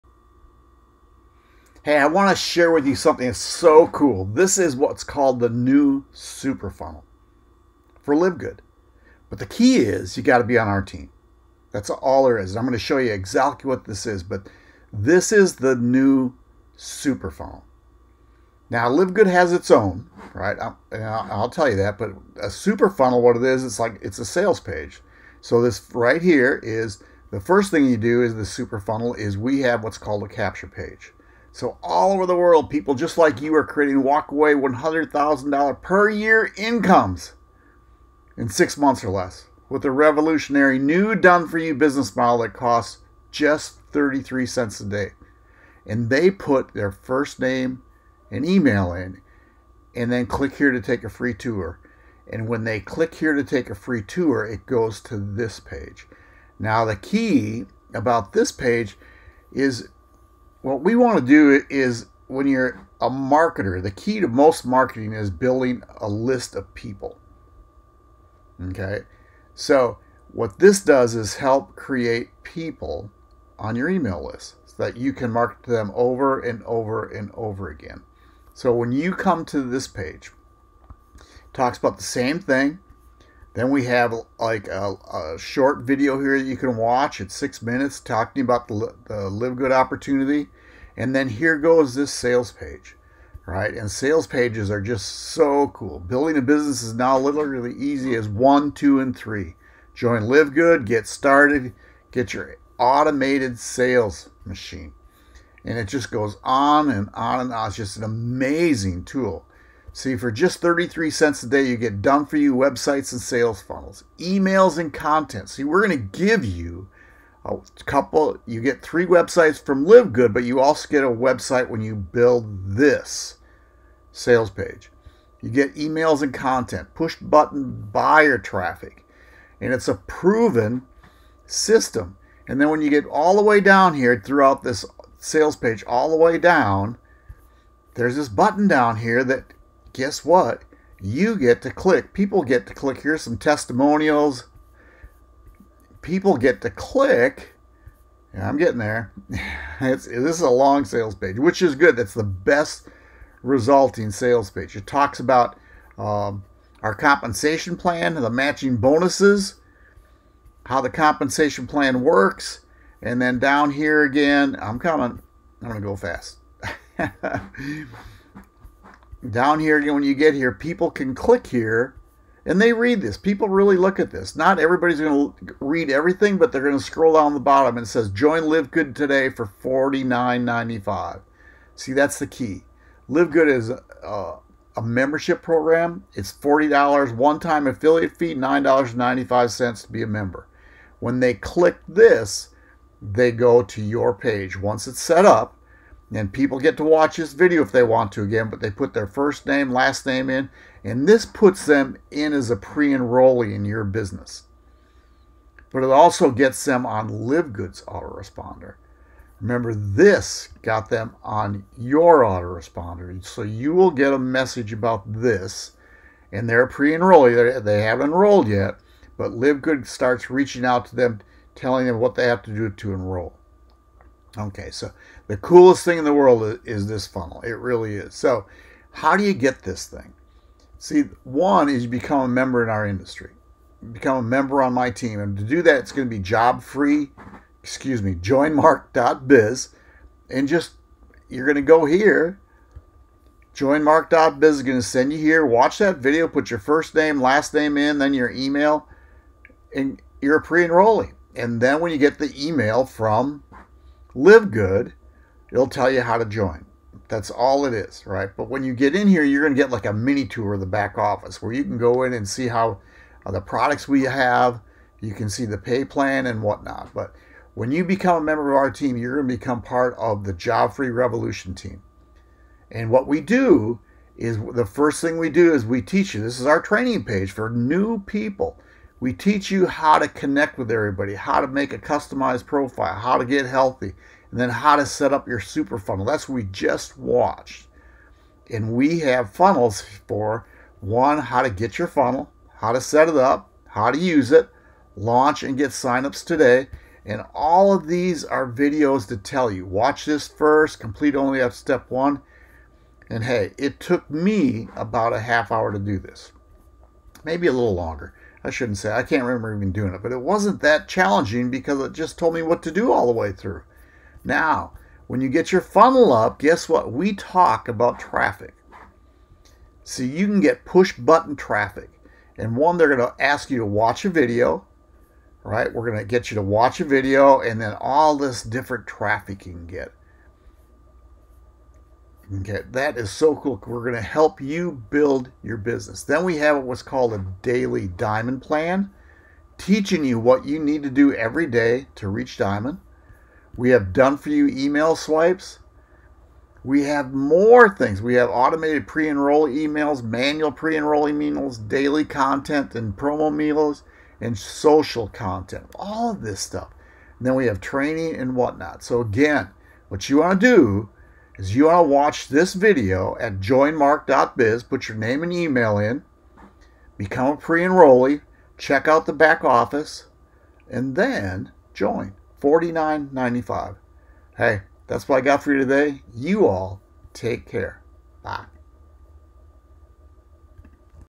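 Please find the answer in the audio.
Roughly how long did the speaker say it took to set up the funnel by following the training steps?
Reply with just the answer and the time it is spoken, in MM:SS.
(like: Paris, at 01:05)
half hour, at 05:05.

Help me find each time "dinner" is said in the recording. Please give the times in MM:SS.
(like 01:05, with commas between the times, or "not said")
not said.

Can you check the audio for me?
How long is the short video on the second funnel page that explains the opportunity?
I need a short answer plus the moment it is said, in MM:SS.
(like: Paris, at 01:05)
6 minutes, at 01:27.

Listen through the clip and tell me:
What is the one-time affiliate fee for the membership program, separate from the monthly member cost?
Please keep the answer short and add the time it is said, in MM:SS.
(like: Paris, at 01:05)
$40, at 03:06.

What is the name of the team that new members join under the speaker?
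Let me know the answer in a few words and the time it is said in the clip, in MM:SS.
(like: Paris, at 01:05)
Job Free Revolution, at 04:30.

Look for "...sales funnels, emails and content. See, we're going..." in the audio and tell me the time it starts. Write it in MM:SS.
01:53.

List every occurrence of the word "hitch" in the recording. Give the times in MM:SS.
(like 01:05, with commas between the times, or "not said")
not said.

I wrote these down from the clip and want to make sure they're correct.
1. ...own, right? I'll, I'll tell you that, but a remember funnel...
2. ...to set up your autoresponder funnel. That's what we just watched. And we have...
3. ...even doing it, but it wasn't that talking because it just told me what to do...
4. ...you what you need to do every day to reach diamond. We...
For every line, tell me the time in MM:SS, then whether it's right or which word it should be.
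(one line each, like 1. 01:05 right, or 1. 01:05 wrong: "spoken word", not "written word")
1. 00:19 wrong: "super", not "remember"
2. 04:44 wrong: "super", not "autoresponder"
3. 05:09 wrong: "challenging", not "talking"
4. 05:40 right.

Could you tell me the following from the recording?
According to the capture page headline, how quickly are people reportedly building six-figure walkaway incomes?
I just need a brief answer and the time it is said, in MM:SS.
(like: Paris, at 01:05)
6 months or less, at 00:38.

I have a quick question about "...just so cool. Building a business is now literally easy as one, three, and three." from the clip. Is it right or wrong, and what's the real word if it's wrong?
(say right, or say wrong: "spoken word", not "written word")
wrong: "two", not "three".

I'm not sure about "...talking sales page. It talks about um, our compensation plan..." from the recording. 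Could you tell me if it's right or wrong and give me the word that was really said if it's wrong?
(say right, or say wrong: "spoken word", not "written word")
wrong: "resulting", not "talking".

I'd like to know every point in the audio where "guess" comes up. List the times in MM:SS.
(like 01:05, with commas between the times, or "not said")
02:19, 05:16.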